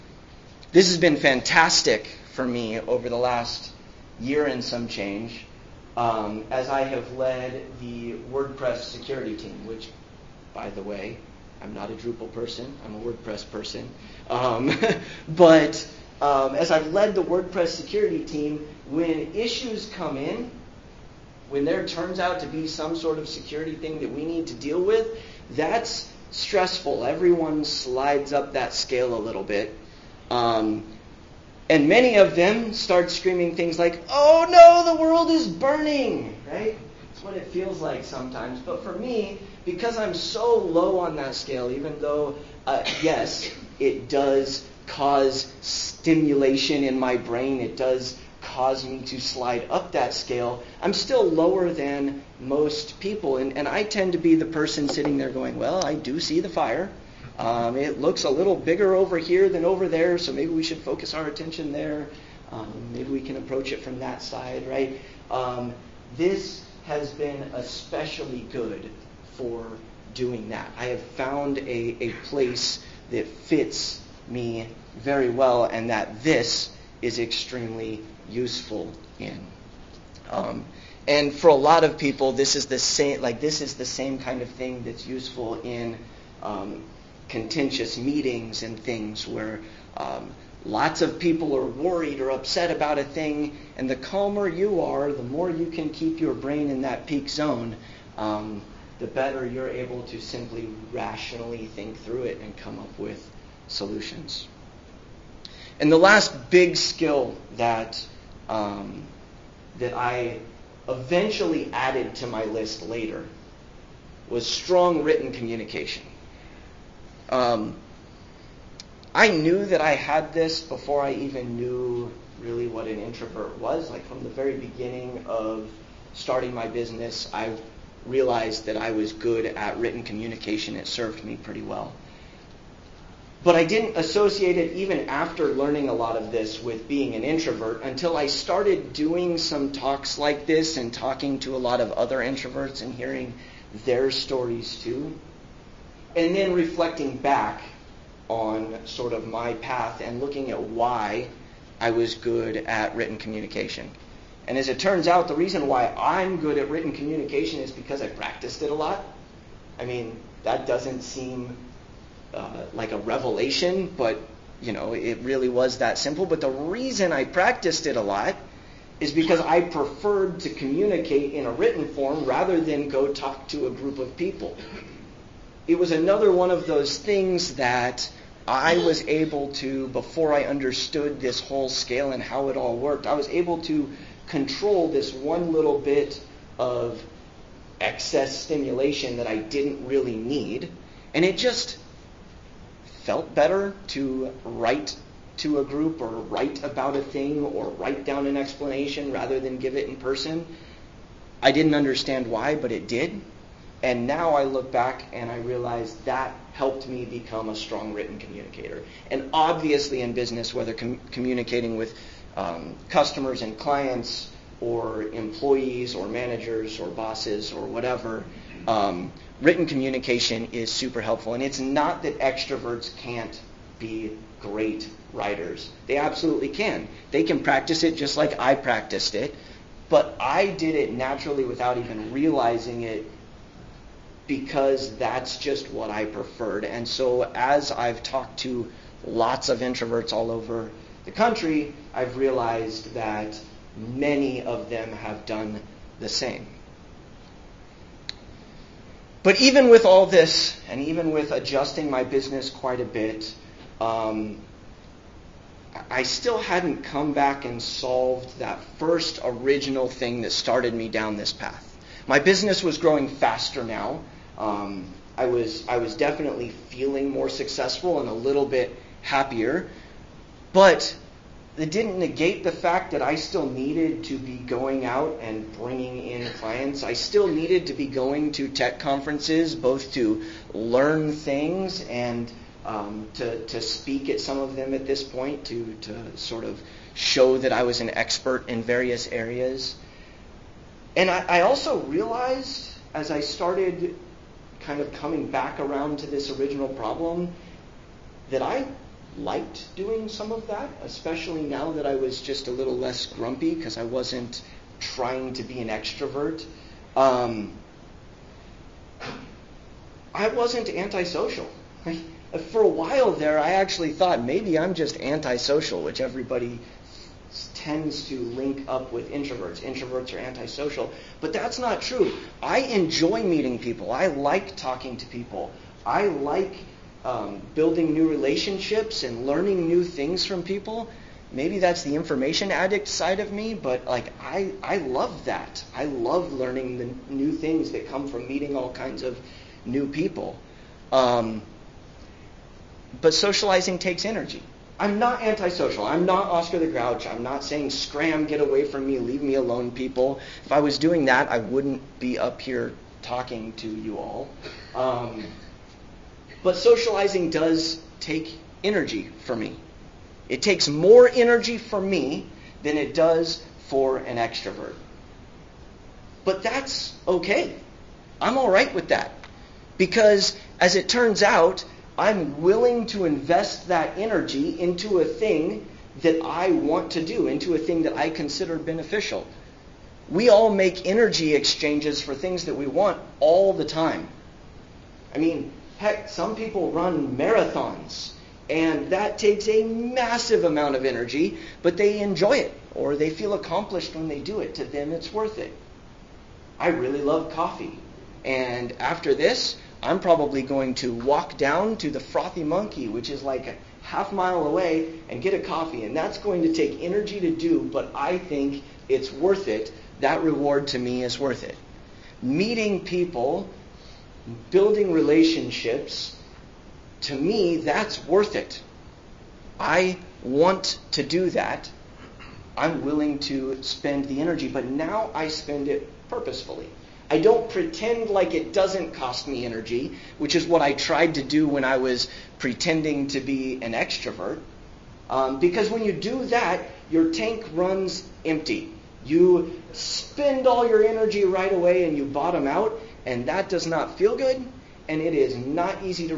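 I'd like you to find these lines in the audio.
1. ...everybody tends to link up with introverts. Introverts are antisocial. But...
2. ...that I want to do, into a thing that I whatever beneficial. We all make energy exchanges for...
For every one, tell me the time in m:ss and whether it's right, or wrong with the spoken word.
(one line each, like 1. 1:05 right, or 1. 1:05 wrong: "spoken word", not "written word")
1. 5:16 right
2. 6:16 wrong: "consider", not "whatever".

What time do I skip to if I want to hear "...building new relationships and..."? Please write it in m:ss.
5:27.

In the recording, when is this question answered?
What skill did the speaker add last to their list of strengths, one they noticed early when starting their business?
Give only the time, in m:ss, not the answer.
1:54.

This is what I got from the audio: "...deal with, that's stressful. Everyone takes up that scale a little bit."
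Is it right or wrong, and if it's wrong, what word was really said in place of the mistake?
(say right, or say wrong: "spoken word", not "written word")
wrong: "slides", not "takes".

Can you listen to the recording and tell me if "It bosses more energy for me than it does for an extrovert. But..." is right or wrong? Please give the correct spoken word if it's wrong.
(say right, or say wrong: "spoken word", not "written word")
wrong: "takes", not "bosses".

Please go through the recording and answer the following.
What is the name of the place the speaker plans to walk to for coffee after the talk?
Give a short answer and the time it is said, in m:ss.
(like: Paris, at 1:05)
Frothy Monkey, at 6:42.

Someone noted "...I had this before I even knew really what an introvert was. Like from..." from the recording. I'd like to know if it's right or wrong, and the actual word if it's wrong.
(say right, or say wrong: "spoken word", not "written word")
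right.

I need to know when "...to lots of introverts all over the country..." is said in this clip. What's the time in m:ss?
3:58.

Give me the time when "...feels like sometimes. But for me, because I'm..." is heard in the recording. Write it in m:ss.
0:37.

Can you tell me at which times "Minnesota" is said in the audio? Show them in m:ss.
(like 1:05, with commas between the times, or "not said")
not said.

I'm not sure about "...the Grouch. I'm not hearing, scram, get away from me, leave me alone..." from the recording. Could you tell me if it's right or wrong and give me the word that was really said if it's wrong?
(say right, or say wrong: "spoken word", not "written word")
wrong: "saying", not "hearing".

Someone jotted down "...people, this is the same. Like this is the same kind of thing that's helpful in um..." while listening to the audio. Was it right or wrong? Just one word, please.
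wrong.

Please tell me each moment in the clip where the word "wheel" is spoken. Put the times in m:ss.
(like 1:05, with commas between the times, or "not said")
not said.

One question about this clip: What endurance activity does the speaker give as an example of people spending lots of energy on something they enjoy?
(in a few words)
Marathons.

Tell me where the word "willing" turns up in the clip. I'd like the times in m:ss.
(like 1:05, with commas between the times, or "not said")
6:12, 7:02.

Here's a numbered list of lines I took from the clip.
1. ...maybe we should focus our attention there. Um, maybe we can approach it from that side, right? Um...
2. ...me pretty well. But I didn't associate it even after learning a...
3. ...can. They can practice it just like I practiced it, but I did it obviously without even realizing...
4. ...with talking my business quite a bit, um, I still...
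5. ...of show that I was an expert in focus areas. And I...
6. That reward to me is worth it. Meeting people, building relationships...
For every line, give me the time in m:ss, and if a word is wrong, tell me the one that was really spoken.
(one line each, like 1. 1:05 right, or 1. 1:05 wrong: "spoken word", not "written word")
1. 1:00 right
2. 2:11 right
3. 3:46 wrong: "naturally", not "obviously"
4. 4:11 wrong: "adjusting", not "talking"
5. 4:46 wrong: "various", not "focus"
6. 6:50 right.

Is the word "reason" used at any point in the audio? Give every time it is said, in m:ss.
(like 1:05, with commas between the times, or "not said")
2:35, 2:46.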